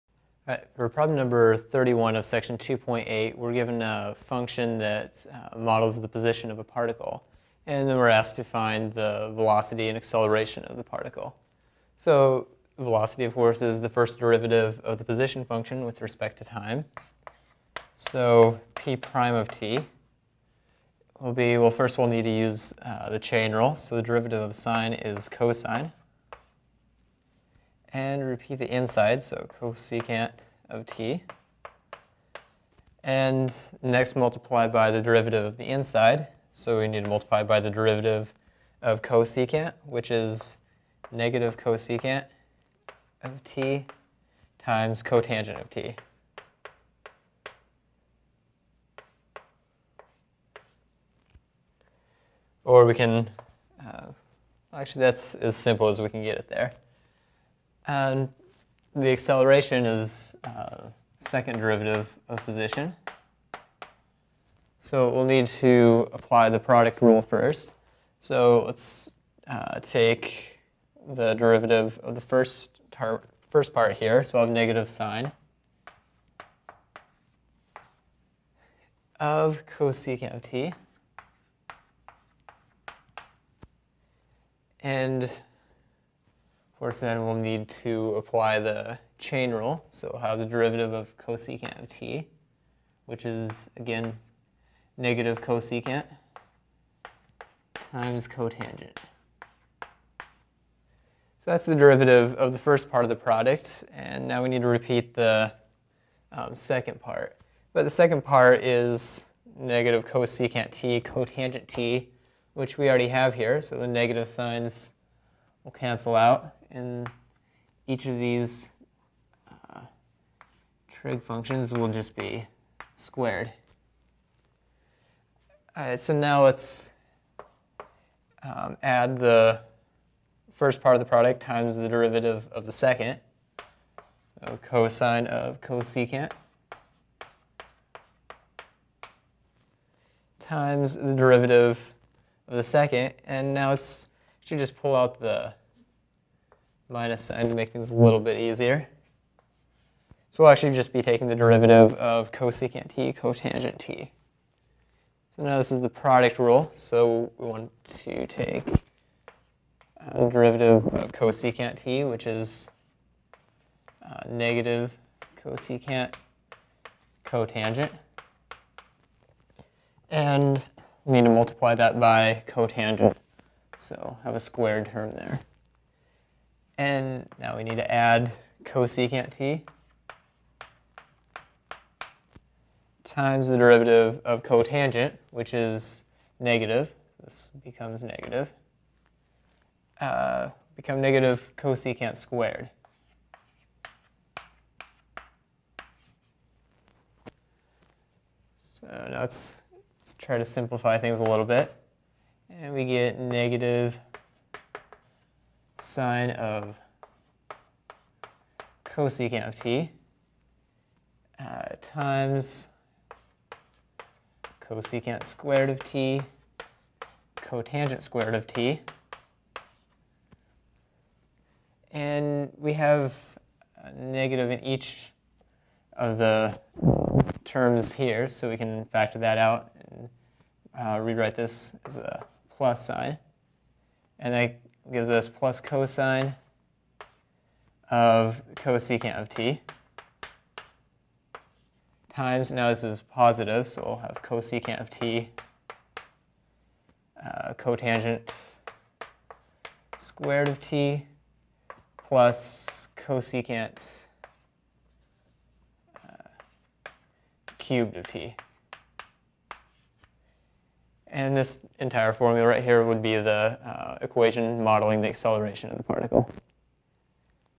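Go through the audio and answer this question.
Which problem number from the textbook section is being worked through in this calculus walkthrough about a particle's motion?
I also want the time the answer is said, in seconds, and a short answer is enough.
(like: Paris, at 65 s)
31, at 1 s.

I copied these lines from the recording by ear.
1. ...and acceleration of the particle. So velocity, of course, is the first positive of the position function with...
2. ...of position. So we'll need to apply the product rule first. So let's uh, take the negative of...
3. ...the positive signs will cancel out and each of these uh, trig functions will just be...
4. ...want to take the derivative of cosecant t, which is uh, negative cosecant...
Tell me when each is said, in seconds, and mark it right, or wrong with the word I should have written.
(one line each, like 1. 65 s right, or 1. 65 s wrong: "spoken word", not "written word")
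1. 9 s wrong: "derivative", not "positive"
2. 62 s wrong: "derivative", not "negative"
3. 113 s wrong: "negative", not "positive"
4. 157 s right.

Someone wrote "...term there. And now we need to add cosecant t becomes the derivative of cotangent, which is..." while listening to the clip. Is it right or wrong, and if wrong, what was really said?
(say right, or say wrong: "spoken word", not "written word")
wrong: "times", not "becomes".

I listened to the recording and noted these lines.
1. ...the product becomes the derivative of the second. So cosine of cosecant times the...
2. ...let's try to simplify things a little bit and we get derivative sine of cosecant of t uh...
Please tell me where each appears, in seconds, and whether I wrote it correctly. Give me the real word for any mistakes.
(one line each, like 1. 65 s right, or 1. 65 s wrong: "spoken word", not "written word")
1. 130 s wrong: "times", not "becomes"
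2. 200 s wrong: "negative", not "derivative".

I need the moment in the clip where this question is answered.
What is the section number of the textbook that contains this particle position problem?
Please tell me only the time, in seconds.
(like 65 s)
2 s.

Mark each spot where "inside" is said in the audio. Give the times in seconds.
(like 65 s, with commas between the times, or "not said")
28 s, 35 s.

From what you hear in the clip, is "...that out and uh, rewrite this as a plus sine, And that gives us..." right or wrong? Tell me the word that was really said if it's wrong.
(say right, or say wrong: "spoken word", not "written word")
right.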